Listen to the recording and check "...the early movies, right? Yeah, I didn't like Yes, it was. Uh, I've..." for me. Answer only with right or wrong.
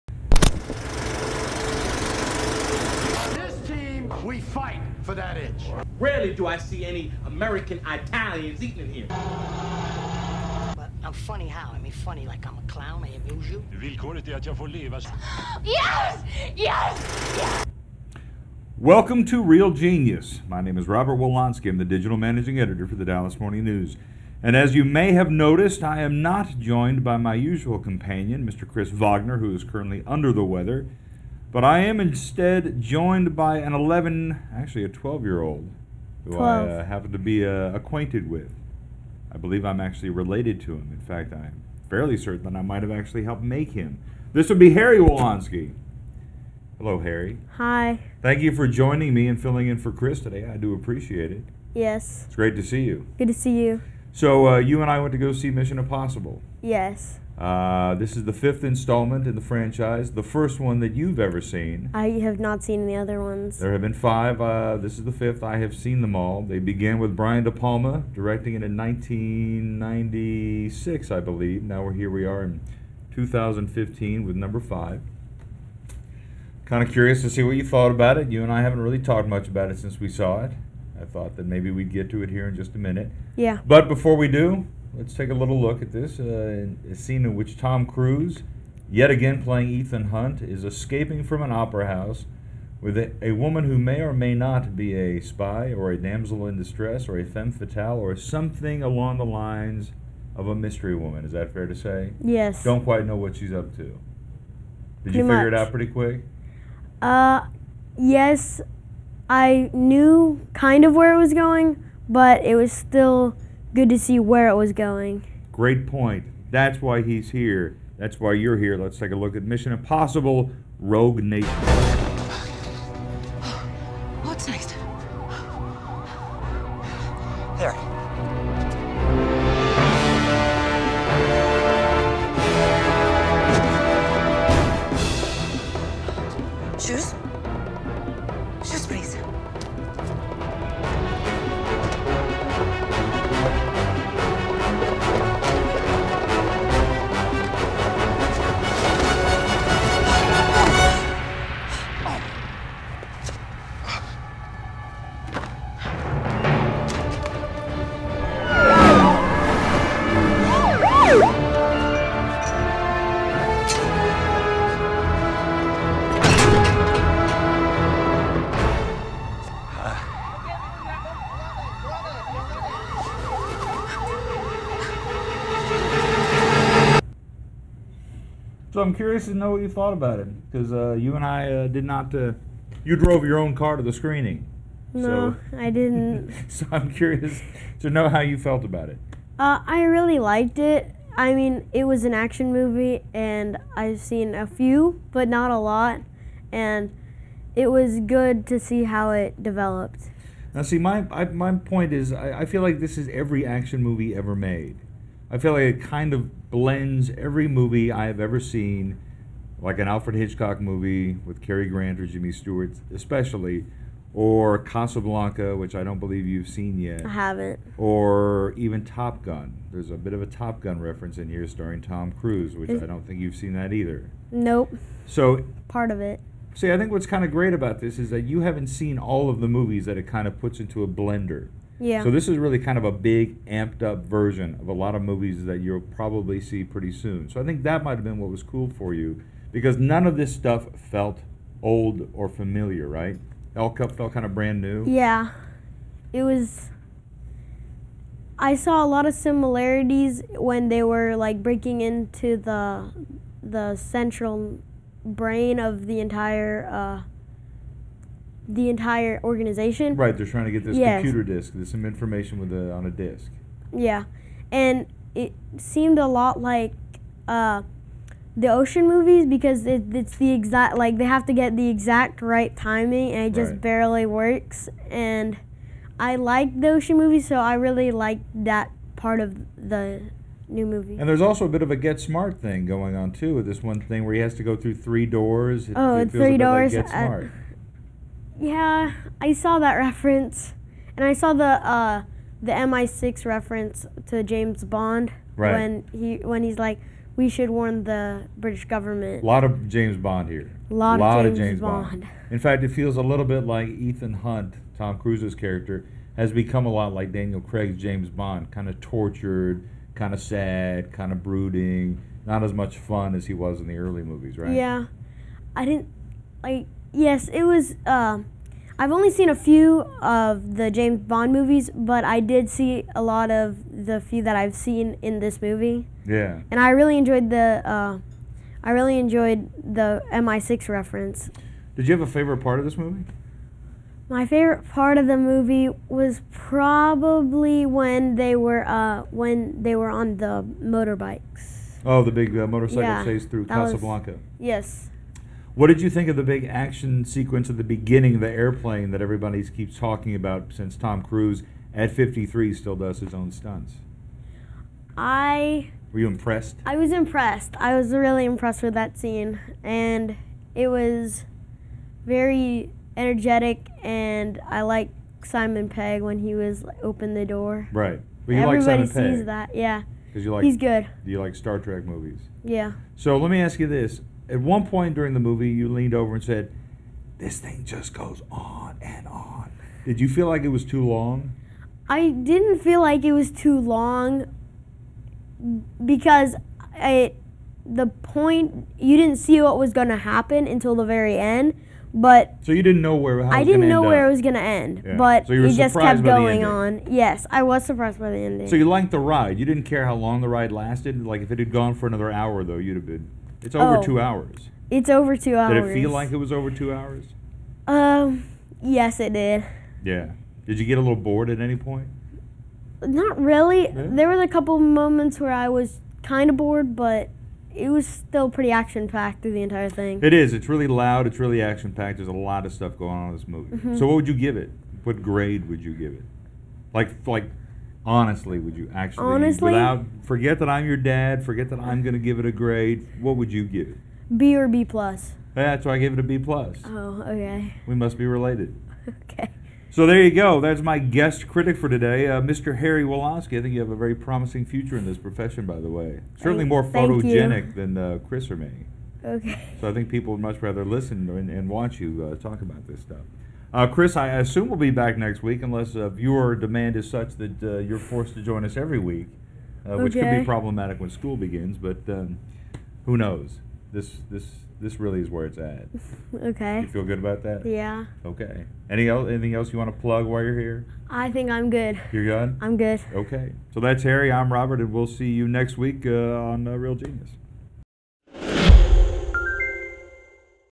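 right.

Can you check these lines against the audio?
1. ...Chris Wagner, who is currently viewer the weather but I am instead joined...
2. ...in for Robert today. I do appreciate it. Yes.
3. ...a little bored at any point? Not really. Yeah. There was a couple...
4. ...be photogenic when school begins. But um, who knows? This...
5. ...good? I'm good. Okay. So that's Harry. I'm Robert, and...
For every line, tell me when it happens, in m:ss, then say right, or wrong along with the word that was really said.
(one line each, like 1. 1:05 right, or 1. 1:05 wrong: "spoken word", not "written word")
1. 0:28 wrong: "under", not "viewer"
2. 0:49 wrong: "Chris", not "Robert"
3. 6:50 right
4. 7:40 wrong: "problematic", not "photogenic"
5. 7:52 right.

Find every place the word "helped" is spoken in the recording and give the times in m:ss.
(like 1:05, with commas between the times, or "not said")
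0:43.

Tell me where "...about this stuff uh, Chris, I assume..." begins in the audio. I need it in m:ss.
7:32.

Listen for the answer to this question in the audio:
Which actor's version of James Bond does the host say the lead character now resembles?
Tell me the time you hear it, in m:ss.
5:07.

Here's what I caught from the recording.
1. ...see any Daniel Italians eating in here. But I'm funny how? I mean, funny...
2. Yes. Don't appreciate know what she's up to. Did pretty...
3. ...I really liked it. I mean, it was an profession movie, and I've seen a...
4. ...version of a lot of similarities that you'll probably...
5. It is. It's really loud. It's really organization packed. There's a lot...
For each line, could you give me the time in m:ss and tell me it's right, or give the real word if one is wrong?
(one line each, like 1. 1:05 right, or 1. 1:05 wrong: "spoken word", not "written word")
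1. 0:06 wrong: "American", not "Daniel"
2. 1:42 wrong: "quite", not "appreciate"
3. 3:09 wrong: "action", not "profession"
4. 3:54 wrong: "movies", not "similarities"
5. 7:00 wrong: "action", not "organization".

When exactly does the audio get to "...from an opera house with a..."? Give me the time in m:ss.
1:31.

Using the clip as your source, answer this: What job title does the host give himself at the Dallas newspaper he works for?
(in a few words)
Digital managing editor.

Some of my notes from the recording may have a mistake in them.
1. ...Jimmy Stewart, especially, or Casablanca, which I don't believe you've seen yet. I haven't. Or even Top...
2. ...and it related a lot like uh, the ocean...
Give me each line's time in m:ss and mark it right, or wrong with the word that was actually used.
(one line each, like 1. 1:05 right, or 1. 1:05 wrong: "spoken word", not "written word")
1. 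3:32 right
2. 4:24 wrong: "seemed", not "related".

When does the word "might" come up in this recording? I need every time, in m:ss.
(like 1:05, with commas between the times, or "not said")
0:42, 3:57.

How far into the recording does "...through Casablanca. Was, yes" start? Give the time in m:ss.
5:43.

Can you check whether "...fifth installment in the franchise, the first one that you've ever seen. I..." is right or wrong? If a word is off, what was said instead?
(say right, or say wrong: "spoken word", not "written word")
right.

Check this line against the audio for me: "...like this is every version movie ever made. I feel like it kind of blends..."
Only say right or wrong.
wrong.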